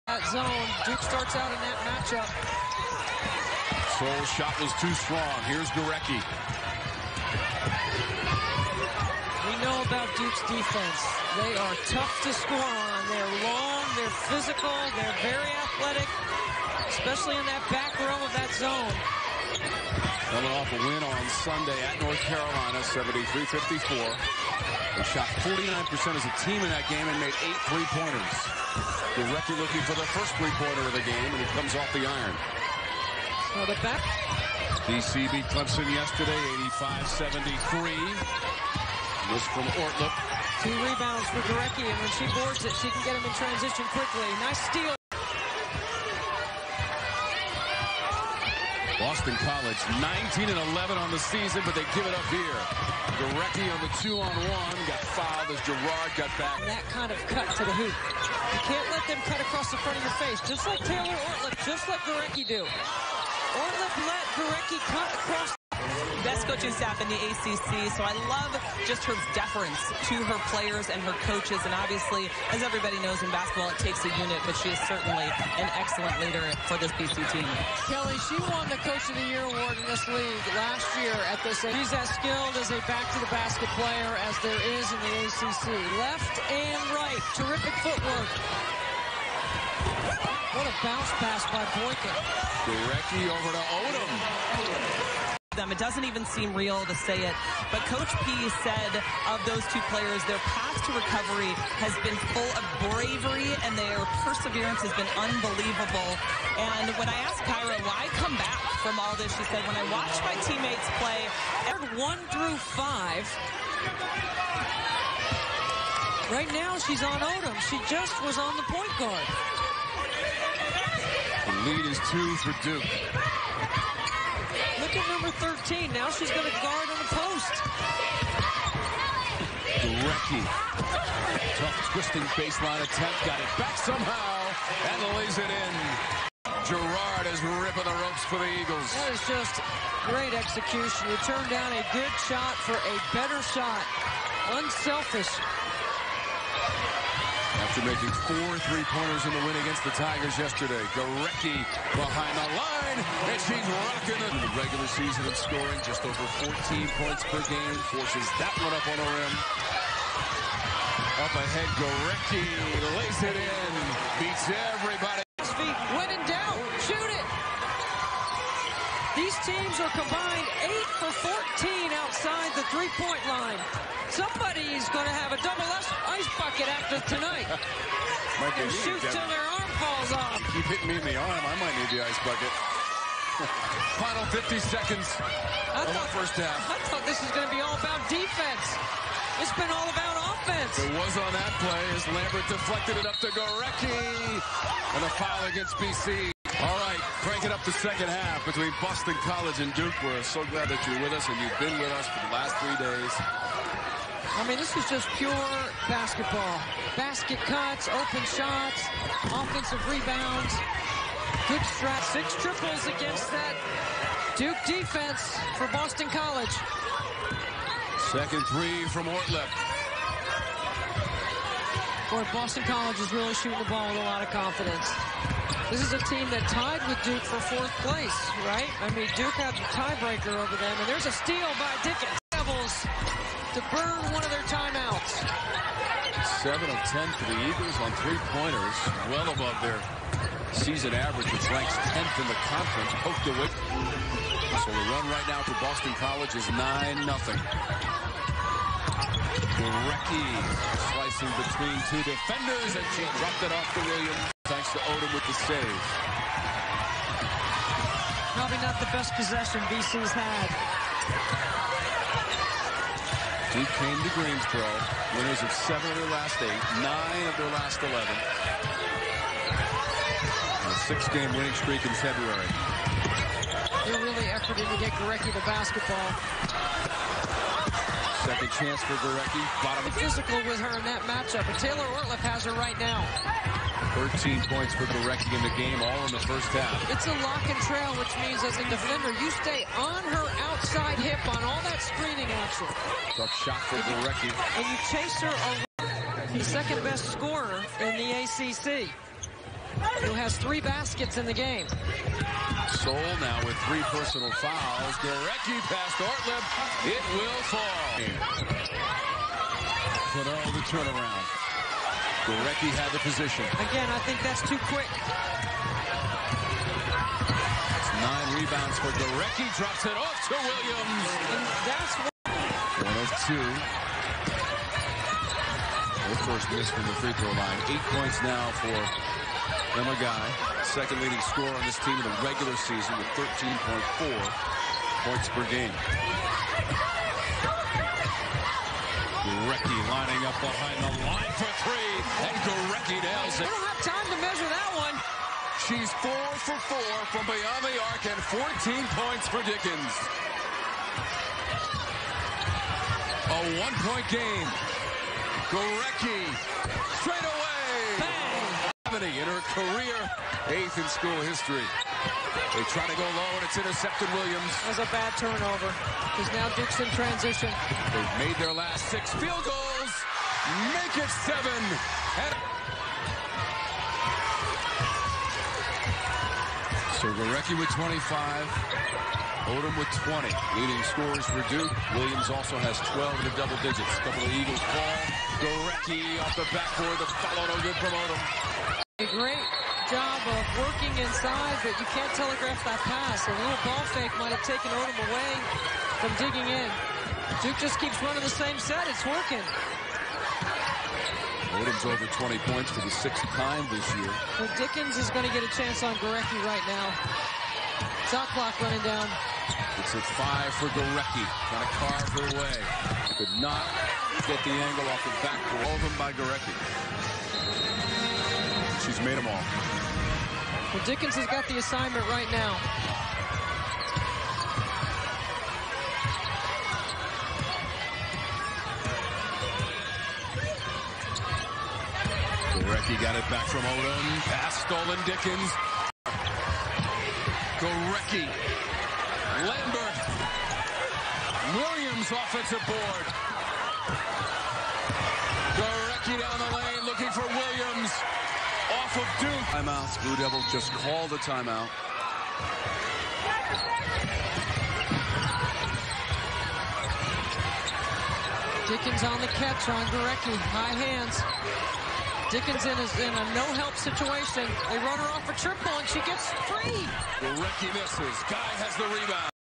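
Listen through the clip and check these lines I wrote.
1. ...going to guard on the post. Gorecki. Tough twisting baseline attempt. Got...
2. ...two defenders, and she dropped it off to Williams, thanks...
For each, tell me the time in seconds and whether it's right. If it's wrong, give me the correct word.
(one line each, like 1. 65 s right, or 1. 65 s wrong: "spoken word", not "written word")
1. 126 s right
2. 251 s right.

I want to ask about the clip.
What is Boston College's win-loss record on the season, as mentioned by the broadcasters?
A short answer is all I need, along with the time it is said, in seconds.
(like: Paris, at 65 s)
19 and 11, at 50 s.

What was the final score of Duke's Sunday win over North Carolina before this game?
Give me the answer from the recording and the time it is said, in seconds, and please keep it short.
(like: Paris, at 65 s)
73-54, at 22 s.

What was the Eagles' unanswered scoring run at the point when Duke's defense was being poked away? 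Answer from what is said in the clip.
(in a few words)
9-0.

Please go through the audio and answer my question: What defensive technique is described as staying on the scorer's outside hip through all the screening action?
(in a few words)
Lock and trail.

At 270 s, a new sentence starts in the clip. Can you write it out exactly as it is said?
And a six-game winning streak in February.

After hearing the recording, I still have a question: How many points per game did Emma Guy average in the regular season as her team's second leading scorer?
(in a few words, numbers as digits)
13.4.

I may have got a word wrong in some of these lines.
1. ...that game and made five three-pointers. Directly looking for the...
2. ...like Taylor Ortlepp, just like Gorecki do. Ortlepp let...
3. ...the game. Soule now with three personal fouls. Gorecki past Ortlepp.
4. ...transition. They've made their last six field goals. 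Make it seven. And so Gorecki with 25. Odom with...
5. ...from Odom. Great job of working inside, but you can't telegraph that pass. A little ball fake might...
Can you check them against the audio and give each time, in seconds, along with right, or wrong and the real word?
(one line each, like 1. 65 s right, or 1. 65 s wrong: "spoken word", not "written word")
1. 26 s wrong: "eight", not "five"
2. 60 s right
3. 301 s right
4. 366 s right
5. 387 s right.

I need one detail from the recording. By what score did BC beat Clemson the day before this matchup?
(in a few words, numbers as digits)
85-73.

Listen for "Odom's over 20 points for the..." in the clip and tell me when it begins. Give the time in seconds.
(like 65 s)
401 s.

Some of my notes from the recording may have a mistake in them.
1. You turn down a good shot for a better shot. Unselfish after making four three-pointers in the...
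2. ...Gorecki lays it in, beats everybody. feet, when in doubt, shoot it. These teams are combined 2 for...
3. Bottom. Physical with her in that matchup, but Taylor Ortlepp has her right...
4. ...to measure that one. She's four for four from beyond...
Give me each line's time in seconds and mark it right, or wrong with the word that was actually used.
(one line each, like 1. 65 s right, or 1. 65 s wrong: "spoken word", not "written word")
1. 141 s right
2. 161 s wrong: "8", not "2"
3. 279 s right
4. 344 s right.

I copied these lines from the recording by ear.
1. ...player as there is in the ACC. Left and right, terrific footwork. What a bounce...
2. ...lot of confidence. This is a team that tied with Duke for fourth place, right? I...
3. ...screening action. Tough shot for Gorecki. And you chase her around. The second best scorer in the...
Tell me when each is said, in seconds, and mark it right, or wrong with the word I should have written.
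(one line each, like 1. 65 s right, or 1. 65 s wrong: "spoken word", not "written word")
1. 83 s right
2. 224 s right
3. 291 s right.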